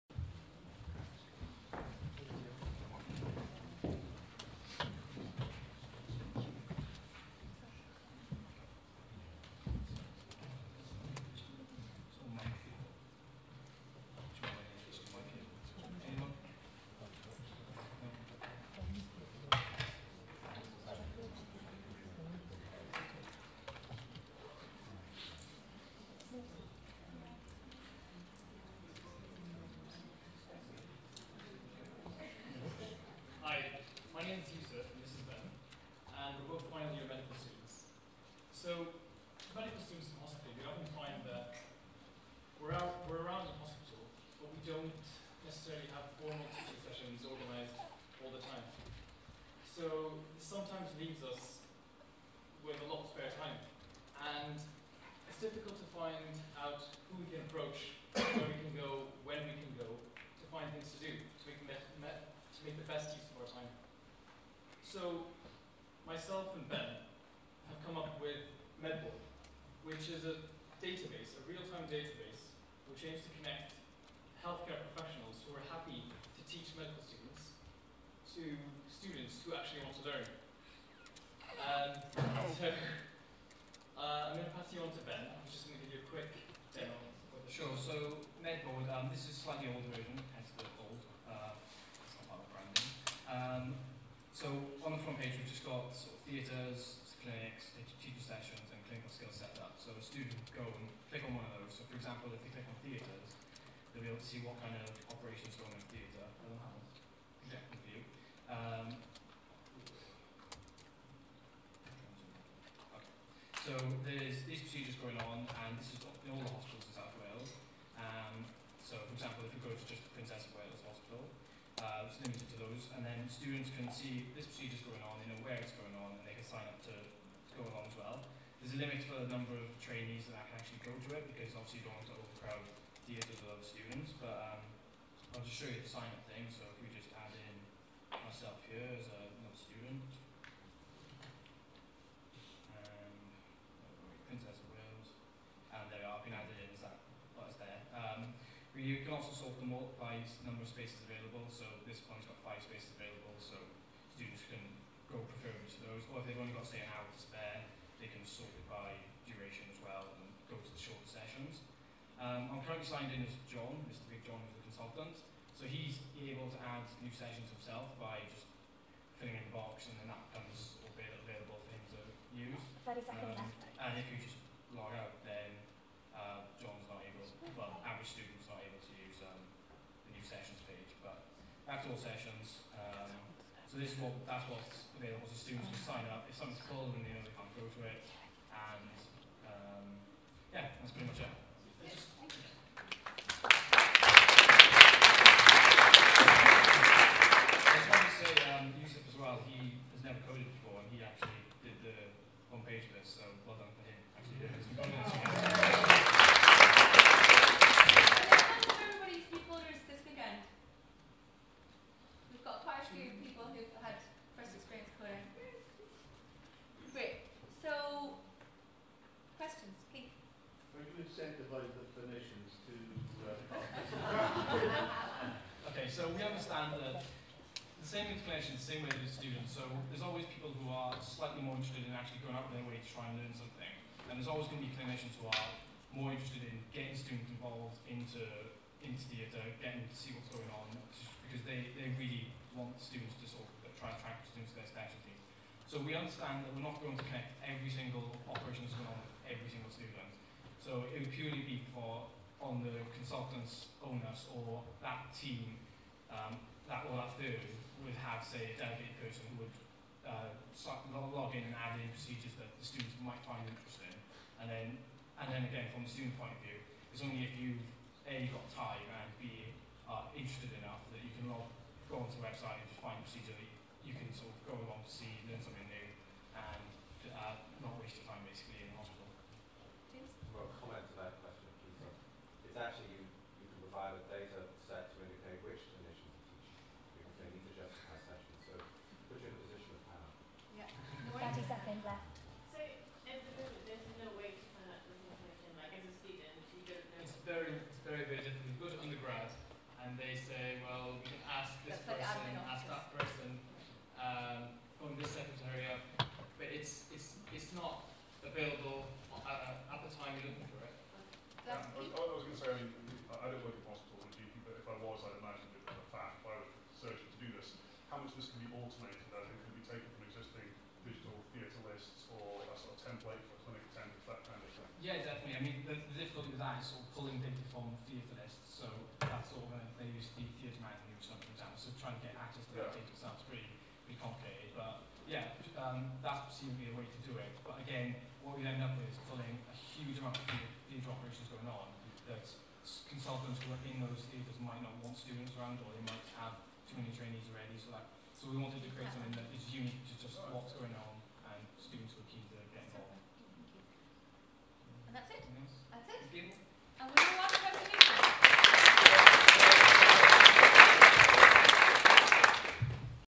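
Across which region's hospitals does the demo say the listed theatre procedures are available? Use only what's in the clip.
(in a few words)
South Wales.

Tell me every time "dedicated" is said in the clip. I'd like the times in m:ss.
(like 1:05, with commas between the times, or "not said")
4:18.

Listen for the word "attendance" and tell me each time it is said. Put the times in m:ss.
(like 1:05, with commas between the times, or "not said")
5:23.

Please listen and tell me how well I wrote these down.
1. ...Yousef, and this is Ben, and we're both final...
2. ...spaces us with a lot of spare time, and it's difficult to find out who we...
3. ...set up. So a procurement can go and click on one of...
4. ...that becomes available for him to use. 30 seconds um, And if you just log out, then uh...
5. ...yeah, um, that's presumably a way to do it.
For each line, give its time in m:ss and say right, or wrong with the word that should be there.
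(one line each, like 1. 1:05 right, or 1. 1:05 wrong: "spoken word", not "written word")
1. 0:34 right
2. 0:51 wrong: "leaves", not "spaces"
3. 1:39 wrong: "student", not "procurement"
4. 2:50 right
5. 5:35 right.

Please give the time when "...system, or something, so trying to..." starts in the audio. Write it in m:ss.
5:30.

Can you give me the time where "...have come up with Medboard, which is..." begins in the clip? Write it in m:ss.
1:07.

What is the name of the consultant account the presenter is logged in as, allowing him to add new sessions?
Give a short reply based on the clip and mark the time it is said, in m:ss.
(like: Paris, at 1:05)
Mr. Big John, at 2:43.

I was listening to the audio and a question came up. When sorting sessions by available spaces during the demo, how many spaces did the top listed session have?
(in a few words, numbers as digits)
5.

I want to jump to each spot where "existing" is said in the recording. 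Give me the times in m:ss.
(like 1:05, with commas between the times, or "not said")
5:20.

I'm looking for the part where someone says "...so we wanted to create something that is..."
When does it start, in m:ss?
5:48.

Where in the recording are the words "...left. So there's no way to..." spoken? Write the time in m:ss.
4:51.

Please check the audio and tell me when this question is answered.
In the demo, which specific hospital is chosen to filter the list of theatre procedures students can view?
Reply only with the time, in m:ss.
2:00.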